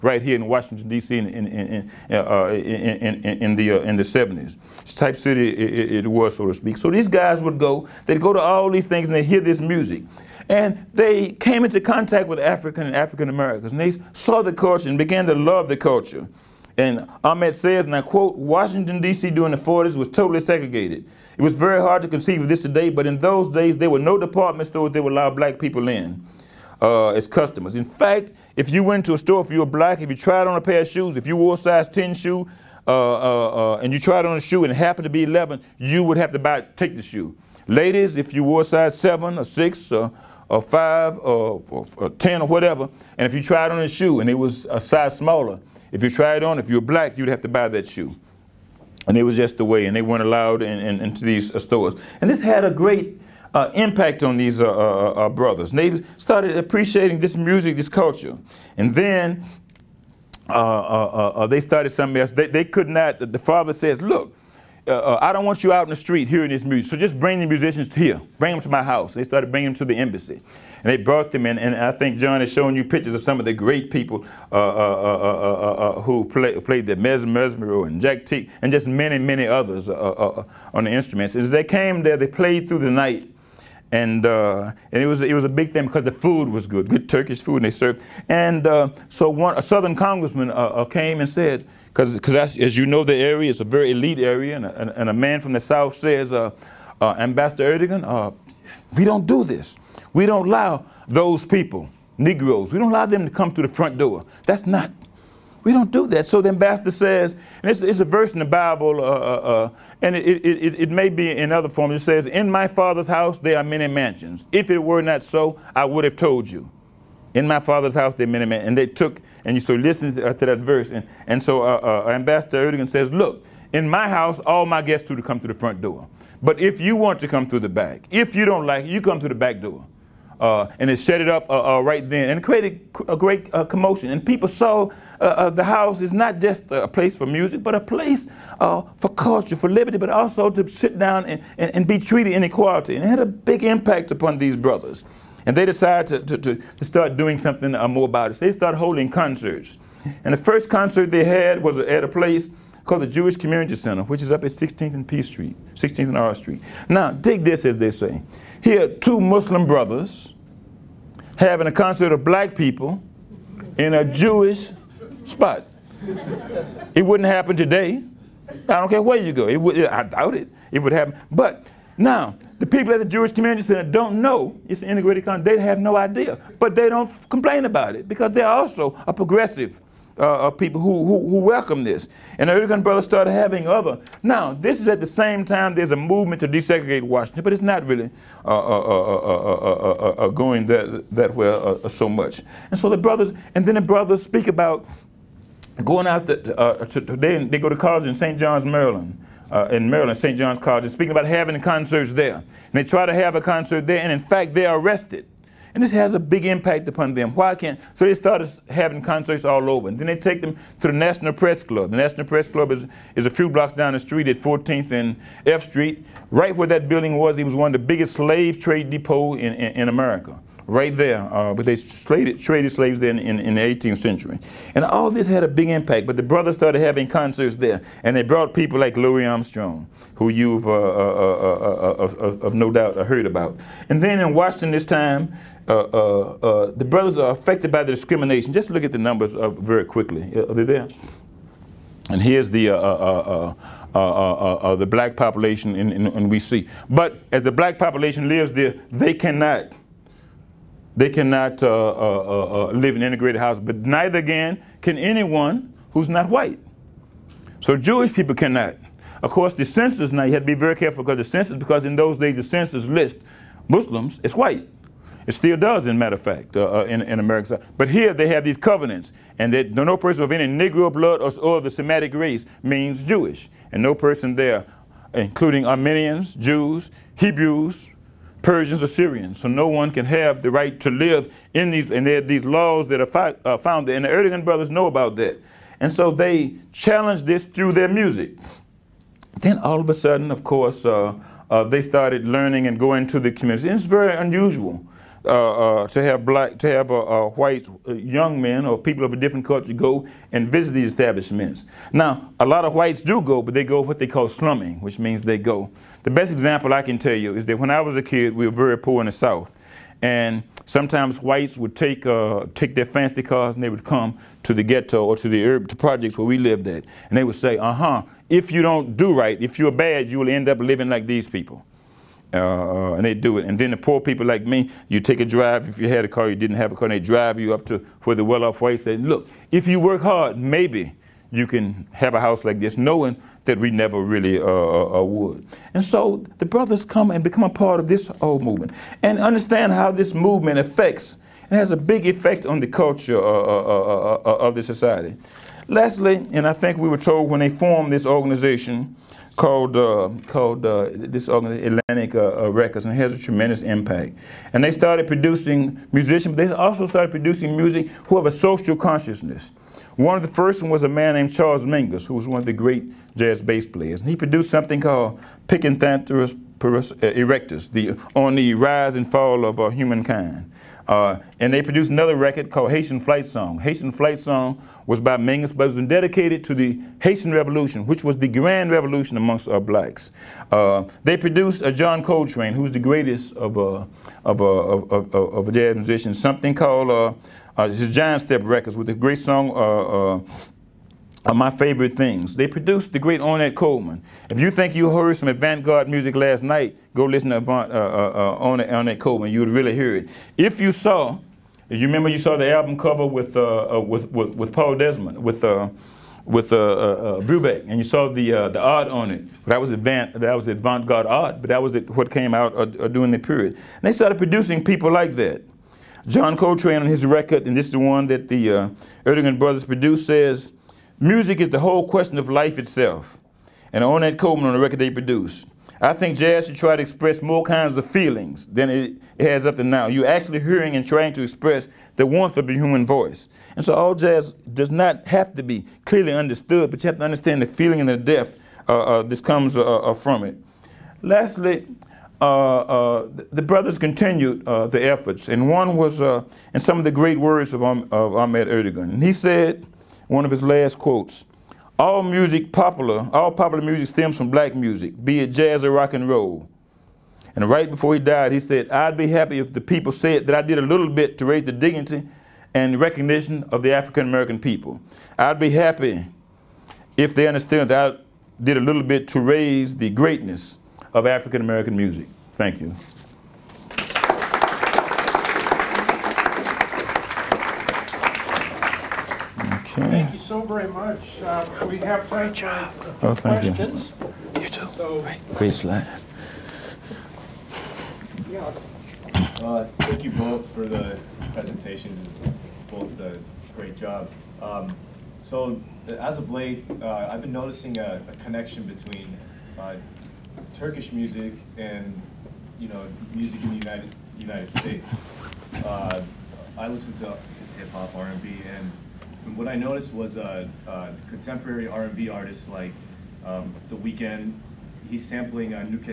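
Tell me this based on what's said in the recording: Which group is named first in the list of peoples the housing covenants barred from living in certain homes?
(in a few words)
Armenians.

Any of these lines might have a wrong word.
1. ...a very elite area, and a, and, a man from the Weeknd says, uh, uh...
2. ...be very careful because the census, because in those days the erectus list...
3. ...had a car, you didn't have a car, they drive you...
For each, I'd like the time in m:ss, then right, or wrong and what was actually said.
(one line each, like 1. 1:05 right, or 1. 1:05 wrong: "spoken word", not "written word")
1. 1:33 wrong: "South", not "Weeknd"
2. 4:20 wrong: "census", not "erectus"
3. 5:25 right.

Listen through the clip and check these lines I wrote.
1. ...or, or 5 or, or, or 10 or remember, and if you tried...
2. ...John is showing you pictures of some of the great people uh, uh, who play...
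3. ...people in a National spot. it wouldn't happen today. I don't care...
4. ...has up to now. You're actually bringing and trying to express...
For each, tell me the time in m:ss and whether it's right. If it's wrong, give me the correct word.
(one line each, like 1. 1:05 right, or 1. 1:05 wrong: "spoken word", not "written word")
1. 0:39 wrong: "whatever", not "remember"
2. 1:12 right
3. 2:42 wrong: "Jewish", not "National"
4. 7:09 wrong: "hearing", not "bringing".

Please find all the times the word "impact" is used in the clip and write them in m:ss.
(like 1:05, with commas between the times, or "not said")
0:53, 2:23, 3:26, 3:45, 5:53.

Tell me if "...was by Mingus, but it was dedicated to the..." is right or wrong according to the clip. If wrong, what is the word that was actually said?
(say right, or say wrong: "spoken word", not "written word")
right.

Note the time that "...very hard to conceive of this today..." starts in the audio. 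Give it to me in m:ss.
0:21.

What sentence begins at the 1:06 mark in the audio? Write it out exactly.
So just bring the musicians here.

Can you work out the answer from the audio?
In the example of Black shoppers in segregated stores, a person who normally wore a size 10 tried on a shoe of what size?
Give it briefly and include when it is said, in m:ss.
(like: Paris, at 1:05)
11, at 0:35.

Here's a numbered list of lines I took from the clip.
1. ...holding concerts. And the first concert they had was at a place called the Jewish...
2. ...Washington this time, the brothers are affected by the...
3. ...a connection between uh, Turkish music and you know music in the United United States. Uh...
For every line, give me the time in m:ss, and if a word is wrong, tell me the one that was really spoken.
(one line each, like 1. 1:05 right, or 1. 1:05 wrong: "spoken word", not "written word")
1. 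2:28 right
2. 3:54 right
3. 8:18 right.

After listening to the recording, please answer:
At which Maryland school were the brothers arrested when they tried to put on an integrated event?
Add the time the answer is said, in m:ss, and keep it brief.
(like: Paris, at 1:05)
St. John's College, at 3:20.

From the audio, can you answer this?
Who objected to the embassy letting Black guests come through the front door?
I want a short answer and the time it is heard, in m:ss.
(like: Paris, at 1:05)
a Southern congressman, at 1:29.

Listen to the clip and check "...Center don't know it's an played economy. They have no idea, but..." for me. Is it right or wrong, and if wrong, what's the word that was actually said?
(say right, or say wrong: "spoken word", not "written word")
wrong: "integrated", not "played".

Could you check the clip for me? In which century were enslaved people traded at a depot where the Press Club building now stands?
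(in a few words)
18th century.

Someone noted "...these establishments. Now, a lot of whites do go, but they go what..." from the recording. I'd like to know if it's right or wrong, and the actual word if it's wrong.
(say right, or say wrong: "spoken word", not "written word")
right.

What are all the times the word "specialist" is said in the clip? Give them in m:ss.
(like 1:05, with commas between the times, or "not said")
not said.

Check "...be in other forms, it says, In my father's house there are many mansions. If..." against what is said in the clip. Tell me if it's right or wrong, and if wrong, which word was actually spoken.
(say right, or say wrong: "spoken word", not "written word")
right.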